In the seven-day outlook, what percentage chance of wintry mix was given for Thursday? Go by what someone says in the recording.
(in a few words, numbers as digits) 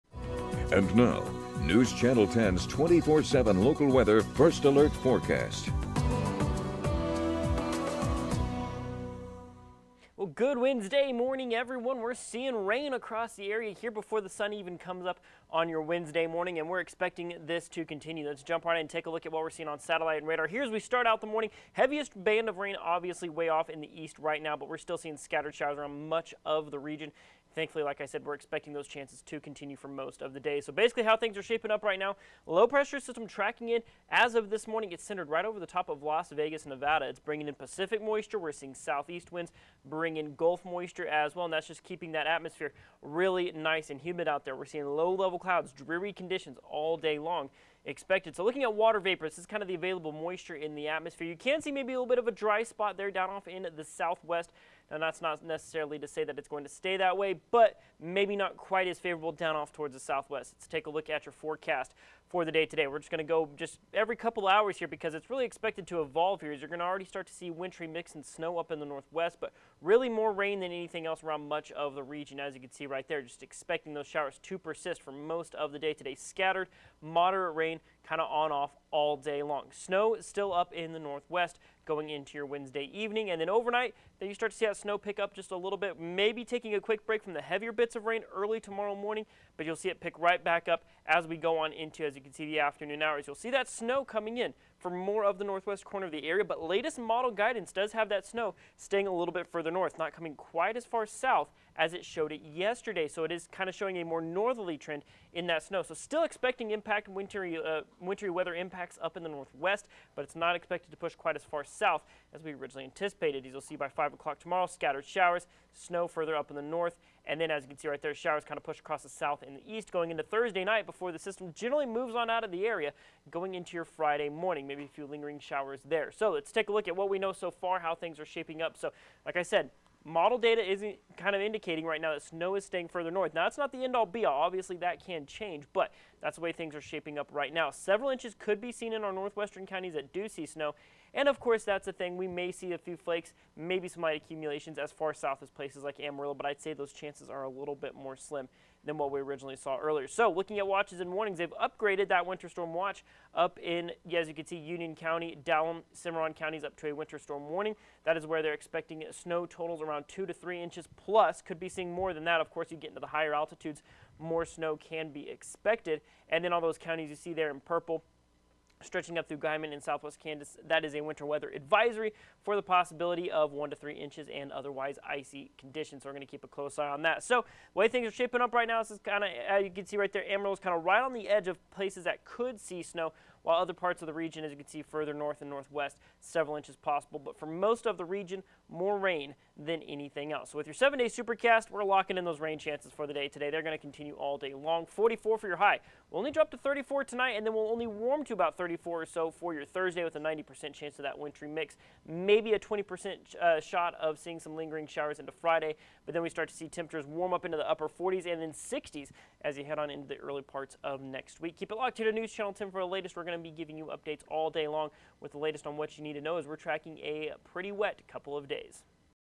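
90%.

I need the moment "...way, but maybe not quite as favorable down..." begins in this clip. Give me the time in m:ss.
0:57.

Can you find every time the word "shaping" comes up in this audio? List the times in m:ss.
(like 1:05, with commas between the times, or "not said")
0:31, 2:08, 2:16, 2:58.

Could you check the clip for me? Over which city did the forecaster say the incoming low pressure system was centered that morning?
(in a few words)
Las Vegas, Nevada.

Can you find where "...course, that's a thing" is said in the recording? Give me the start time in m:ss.
2:21.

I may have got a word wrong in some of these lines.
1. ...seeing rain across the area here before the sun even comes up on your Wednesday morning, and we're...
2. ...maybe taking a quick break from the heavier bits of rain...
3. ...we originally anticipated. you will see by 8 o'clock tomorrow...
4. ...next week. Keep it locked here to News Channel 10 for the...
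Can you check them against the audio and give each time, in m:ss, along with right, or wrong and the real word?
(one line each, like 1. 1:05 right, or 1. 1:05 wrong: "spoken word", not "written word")
1. 0:12 right
2. 1:25 right
3. 1:52 wrong: "5", not "8"
4. 3:31 right.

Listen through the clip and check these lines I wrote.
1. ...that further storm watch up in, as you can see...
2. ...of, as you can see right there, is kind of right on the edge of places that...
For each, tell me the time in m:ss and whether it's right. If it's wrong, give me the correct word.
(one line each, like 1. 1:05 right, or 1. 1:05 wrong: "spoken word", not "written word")
1. 2:32 wrong: "winter", not "further"
2. 2:59 right.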